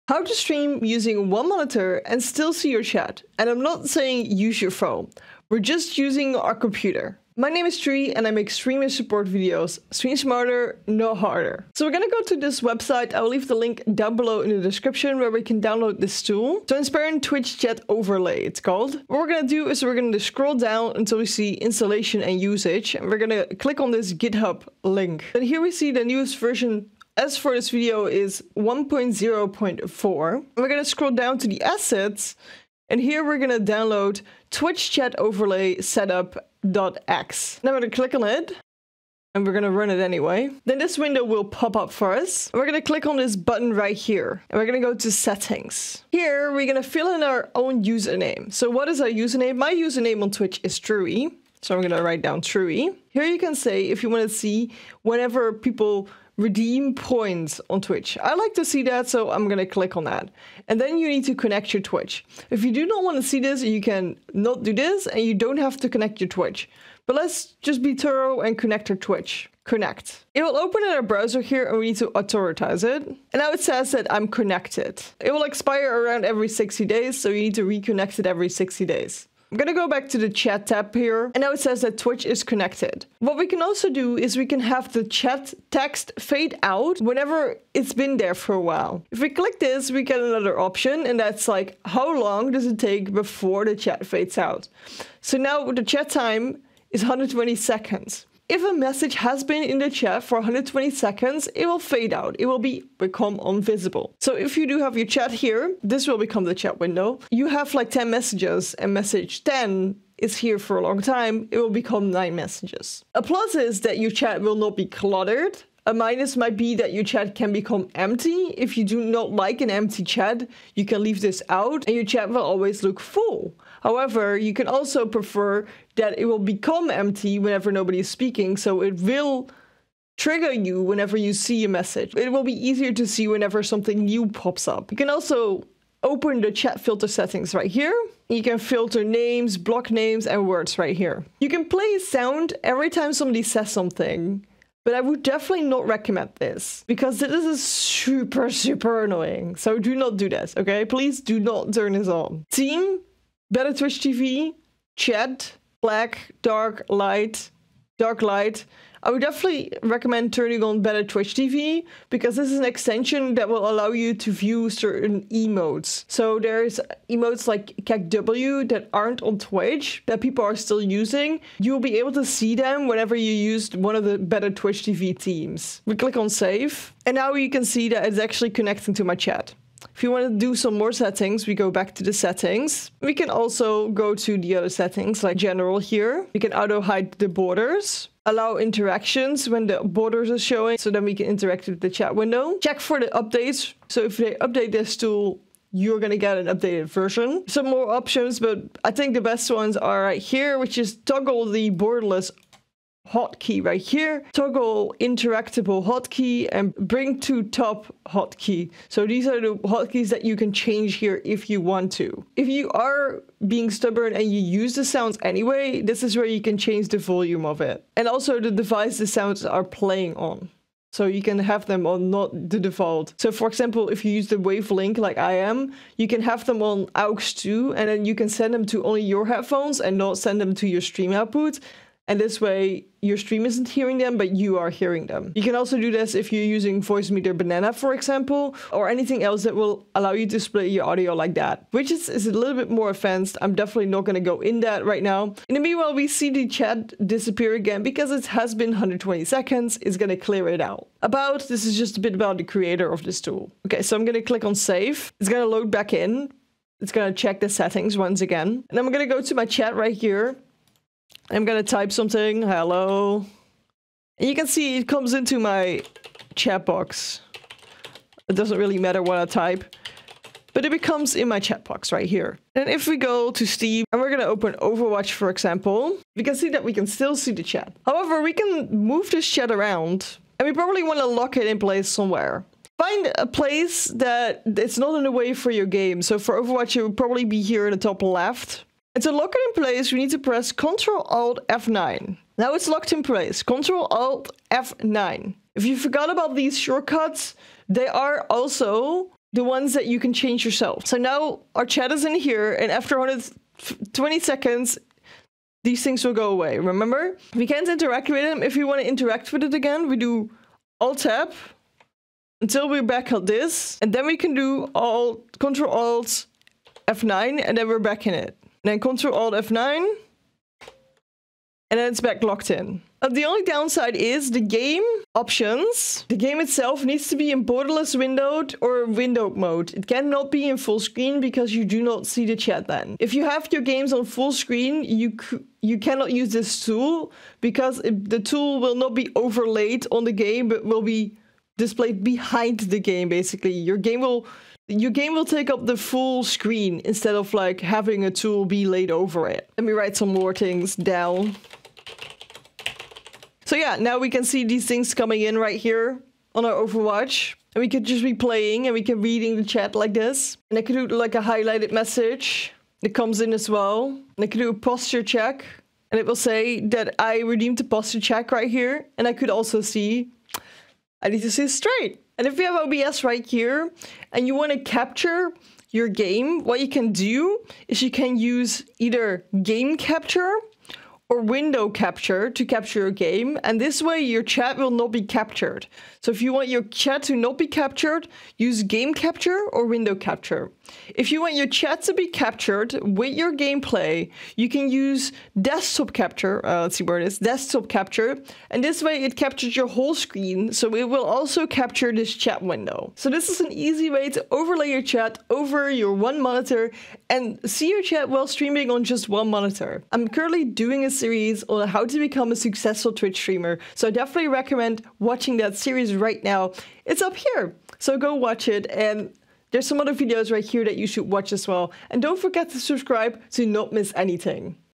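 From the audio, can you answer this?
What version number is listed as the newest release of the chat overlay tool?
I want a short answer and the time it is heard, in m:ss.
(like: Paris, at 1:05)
1.0.4, at 0:28.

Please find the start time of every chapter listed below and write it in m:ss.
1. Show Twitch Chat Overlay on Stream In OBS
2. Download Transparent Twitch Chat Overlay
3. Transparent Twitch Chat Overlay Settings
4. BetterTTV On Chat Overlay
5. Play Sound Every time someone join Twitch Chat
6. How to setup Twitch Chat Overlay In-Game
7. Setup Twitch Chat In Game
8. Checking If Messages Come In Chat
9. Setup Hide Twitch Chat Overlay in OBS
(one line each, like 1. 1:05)
1. 6:30
2. 0:11
3. 2:59
4. 2:33
5. 2:21
6. 0:41
7. 4:32
8. 4:19
9. 6:12.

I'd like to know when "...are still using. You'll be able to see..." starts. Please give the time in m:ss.
2:50.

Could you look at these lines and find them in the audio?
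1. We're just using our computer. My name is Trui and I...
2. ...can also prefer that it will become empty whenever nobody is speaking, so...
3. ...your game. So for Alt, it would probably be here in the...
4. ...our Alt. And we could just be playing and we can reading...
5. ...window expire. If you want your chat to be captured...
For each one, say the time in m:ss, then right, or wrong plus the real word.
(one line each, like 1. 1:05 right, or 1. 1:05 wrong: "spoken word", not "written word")
1. 0:05 right
2. 2:04 right
3. 4:45 wrong: "Overwatch", not "Alt"
4. 5:56 wrong: "Overwatch", not "Alt"
5. 6:29 wrong: "capture", not "expire".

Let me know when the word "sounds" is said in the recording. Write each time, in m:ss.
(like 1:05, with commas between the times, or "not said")
2:21, 3:34, 3:39.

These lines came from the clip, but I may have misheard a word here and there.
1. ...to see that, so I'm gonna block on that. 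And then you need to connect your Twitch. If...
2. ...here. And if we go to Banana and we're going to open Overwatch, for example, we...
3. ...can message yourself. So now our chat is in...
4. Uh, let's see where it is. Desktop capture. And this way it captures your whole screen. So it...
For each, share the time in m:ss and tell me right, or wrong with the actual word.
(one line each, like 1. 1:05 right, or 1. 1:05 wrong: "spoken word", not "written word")
1. 0:58 wrong: "click", not "block"
2. 4:32 wrong: "Steam", not "Banana"
3. 4:59 wrong: "change", not "message"
4. 6:36 right.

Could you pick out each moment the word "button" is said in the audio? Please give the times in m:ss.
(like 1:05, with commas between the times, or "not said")
0:43.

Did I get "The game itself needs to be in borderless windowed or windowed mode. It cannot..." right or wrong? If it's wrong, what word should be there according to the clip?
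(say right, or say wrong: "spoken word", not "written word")
right.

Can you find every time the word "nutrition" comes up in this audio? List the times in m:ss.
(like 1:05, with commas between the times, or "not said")
not said.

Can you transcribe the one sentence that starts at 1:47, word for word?
You have like 10 messages and message 10 is here for a long time, it will become nine messages.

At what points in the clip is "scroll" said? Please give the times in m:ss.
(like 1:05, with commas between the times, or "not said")
0:20, 0:30.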